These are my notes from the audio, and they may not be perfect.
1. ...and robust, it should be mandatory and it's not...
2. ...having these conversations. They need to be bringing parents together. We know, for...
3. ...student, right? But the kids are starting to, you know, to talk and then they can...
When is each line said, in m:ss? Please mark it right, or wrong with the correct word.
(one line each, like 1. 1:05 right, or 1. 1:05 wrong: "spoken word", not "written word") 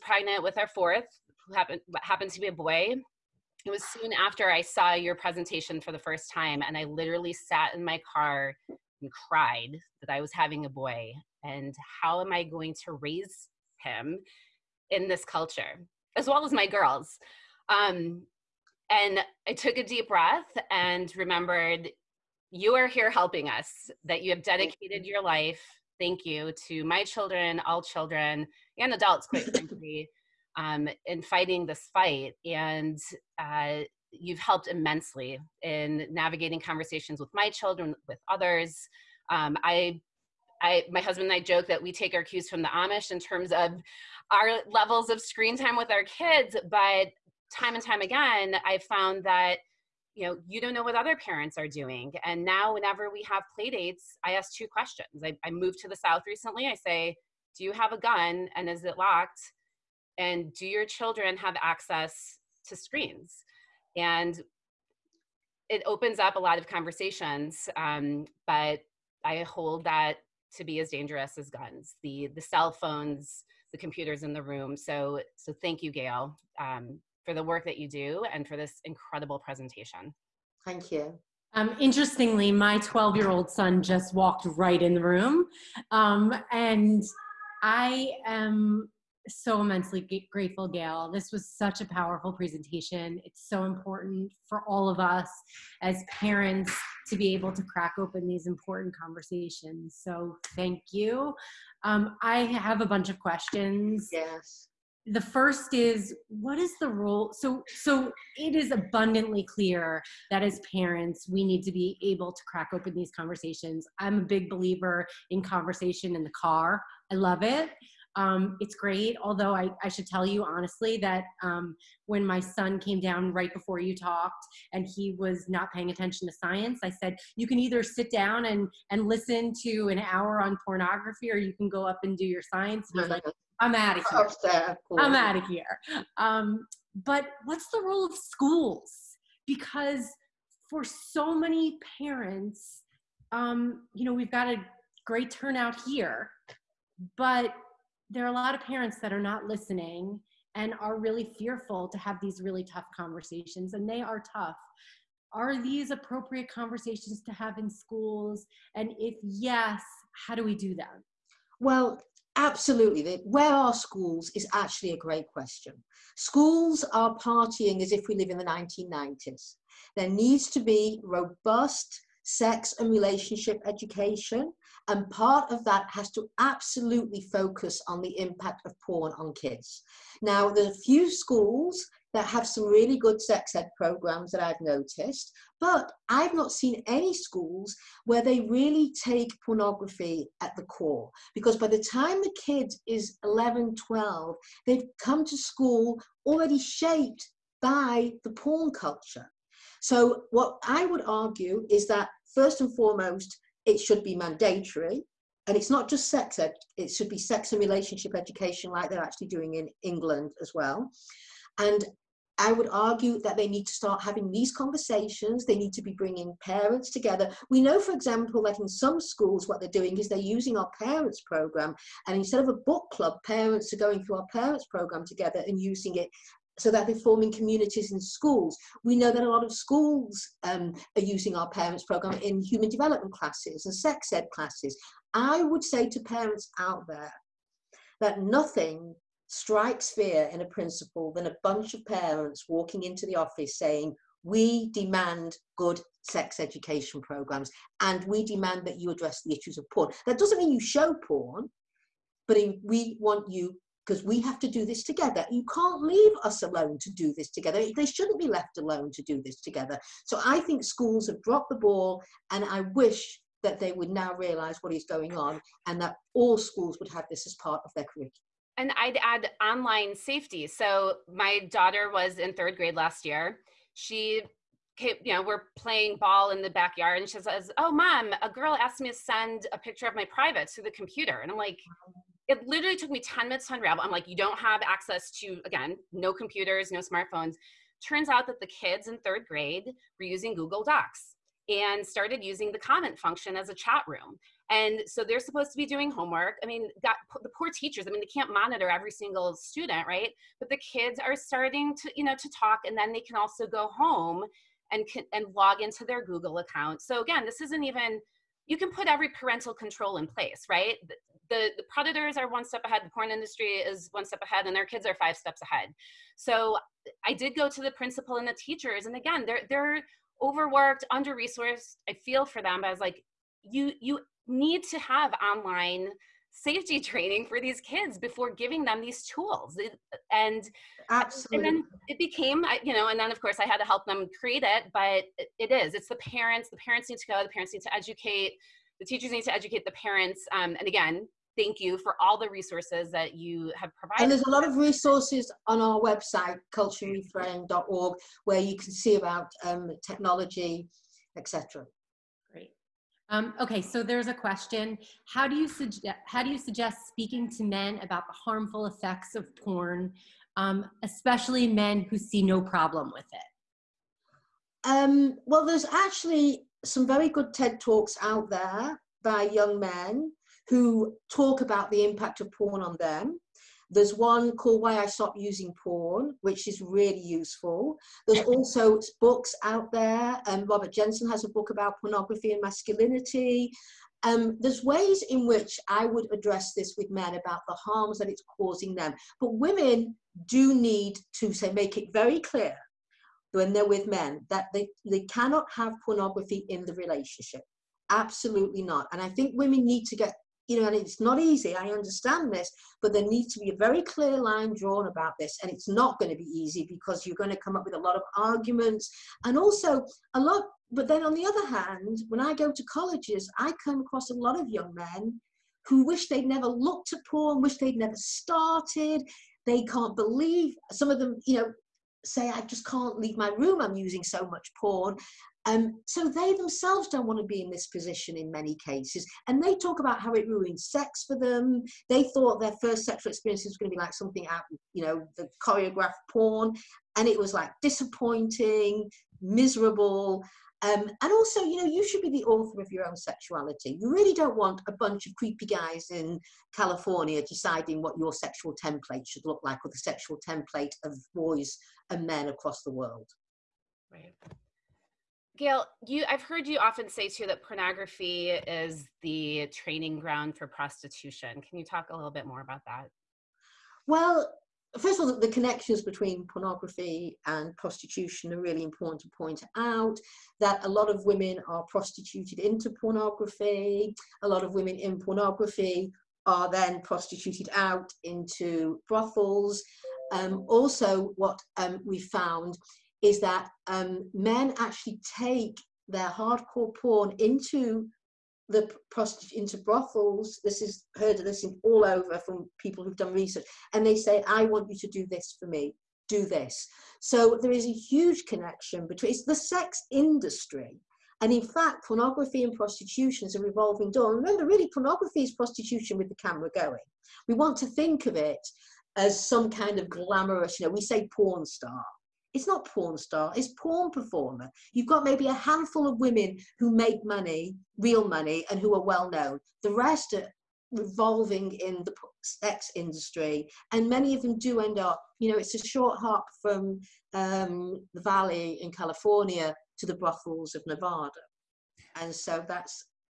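1. 3:22 wrong: "foremost", not "robust"
2. 3:34 right
3. 4:59 right.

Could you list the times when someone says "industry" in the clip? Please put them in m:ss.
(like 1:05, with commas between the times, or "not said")
5:13, 8:19, 8:42.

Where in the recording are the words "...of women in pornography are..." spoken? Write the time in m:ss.
7:54.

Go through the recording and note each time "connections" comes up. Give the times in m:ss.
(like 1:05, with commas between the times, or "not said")
7:45, 8:18.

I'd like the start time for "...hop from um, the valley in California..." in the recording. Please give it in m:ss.
8:45.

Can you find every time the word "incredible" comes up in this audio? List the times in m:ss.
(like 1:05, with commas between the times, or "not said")
1:18.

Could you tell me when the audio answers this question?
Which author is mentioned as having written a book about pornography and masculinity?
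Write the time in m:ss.
6:20.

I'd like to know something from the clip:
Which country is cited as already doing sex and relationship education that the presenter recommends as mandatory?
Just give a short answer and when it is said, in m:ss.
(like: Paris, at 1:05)
England, at 3:29.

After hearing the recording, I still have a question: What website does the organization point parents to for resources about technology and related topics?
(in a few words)
culturereframed.org.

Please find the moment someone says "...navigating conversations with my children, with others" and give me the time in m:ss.
0:36.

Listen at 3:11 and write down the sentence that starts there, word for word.
Because by the time the kid is 11, 12, they've come to school already shaped by the porn culture.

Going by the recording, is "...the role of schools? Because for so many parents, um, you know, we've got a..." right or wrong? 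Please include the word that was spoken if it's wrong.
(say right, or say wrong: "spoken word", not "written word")
right.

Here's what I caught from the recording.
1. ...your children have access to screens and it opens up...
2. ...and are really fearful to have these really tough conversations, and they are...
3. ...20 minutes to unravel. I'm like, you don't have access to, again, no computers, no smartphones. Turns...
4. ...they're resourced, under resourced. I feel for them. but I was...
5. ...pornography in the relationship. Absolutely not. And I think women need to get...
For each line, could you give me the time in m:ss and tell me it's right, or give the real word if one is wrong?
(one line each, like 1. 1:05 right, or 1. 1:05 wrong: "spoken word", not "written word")
1. 1:00 right
2. 2:30 right
3. 4:42 wrong: "10", not "20"
4. 5:19 wrong: "overworked", not "resourced"
5. 6:35 right.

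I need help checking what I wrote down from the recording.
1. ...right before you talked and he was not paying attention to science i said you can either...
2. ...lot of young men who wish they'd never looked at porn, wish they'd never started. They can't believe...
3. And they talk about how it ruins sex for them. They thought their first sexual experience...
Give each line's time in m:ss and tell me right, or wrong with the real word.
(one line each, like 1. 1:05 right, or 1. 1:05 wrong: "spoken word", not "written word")
1. 2:03 right
2. 6:54 right
3. 7:09 right.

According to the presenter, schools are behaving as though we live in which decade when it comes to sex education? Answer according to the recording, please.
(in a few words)
1990s.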